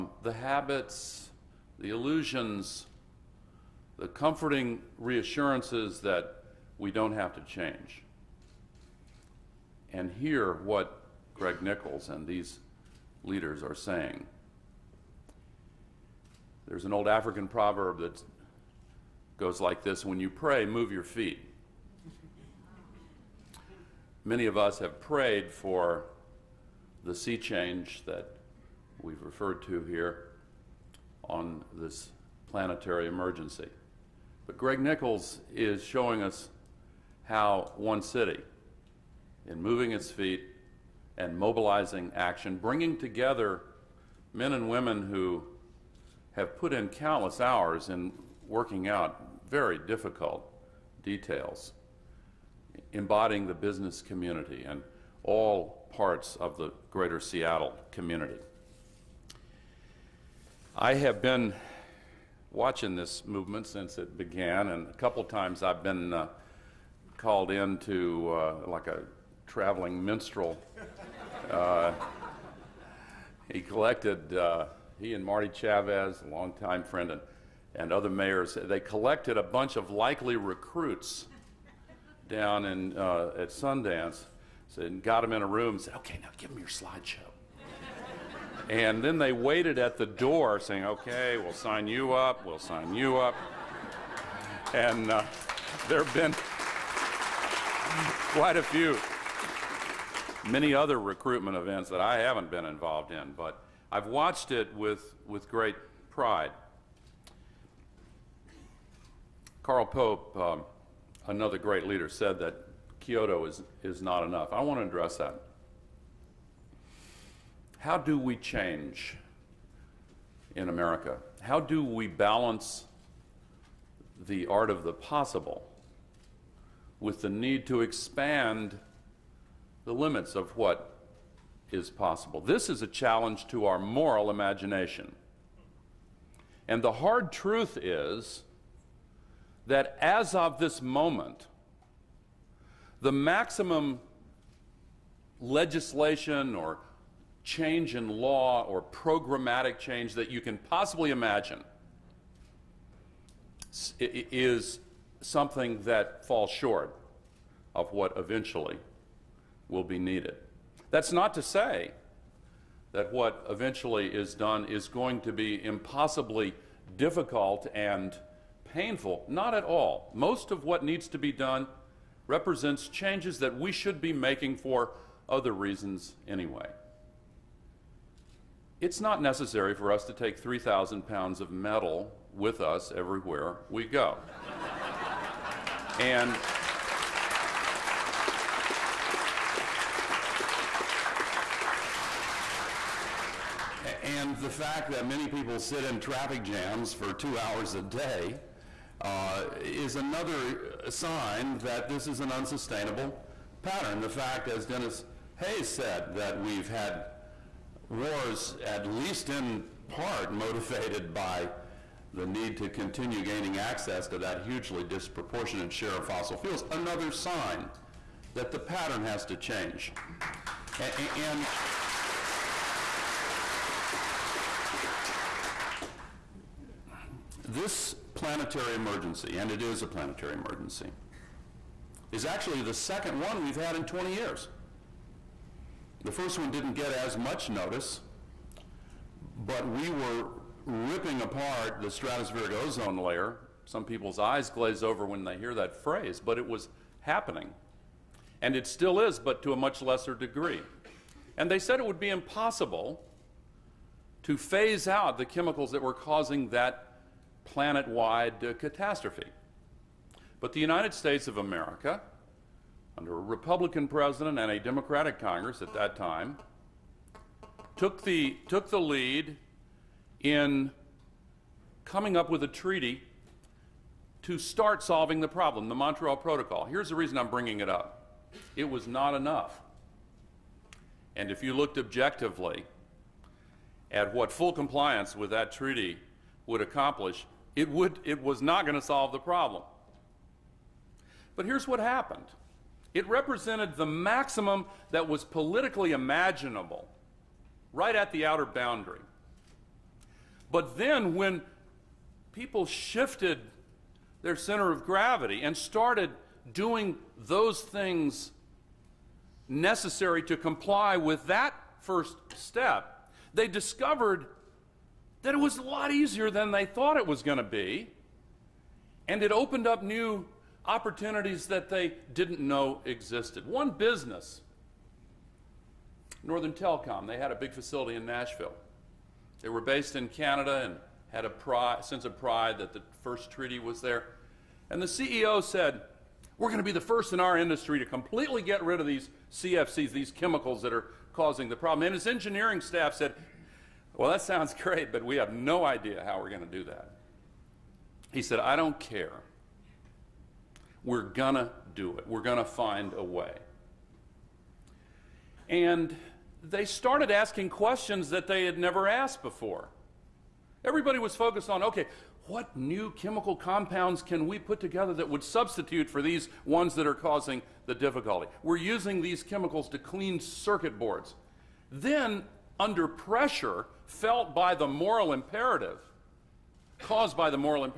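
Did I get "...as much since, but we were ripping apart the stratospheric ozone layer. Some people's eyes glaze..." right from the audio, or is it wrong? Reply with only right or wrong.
wrong.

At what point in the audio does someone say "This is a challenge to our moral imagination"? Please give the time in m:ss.
2:12.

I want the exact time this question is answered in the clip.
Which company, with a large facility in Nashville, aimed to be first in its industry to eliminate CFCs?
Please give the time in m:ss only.
5:26.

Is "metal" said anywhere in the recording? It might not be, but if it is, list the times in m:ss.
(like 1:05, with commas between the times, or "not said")
3:01.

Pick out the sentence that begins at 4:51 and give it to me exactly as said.
But here's what happened it represented the maximum that was politically imaginable, right at the outer boundary.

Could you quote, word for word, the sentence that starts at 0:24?
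Many of us have prayed for the sea change that we've referred to here on this planetary emergency.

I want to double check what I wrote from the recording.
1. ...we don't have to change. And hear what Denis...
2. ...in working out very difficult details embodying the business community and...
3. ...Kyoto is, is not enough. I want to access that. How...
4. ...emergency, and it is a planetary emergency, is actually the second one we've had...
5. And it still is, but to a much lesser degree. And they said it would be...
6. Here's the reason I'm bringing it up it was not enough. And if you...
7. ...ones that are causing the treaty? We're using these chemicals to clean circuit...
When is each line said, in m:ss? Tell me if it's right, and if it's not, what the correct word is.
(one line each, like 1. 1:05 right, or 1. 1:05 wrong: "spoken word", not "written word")
1. 0:06 wrong: "Greg", not "Denis"
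2. 0:47 right
3. 1:53 wrong: "address", not "access"
4. 3:48 right
5. 4:08 right
6. 4:36 right
7. 6:06 wrong: "difficulty", not "treaty".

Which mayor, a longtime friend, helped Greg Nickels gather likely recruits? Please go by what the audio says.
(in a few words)
Marty Chavez.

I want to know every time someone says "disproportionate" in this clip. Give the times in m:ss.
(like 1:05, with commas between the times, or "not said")
3:34.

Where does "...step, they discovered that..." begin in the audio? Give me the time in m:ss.
5:12.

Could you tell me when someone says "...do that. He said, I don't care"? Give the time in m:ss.
5:46.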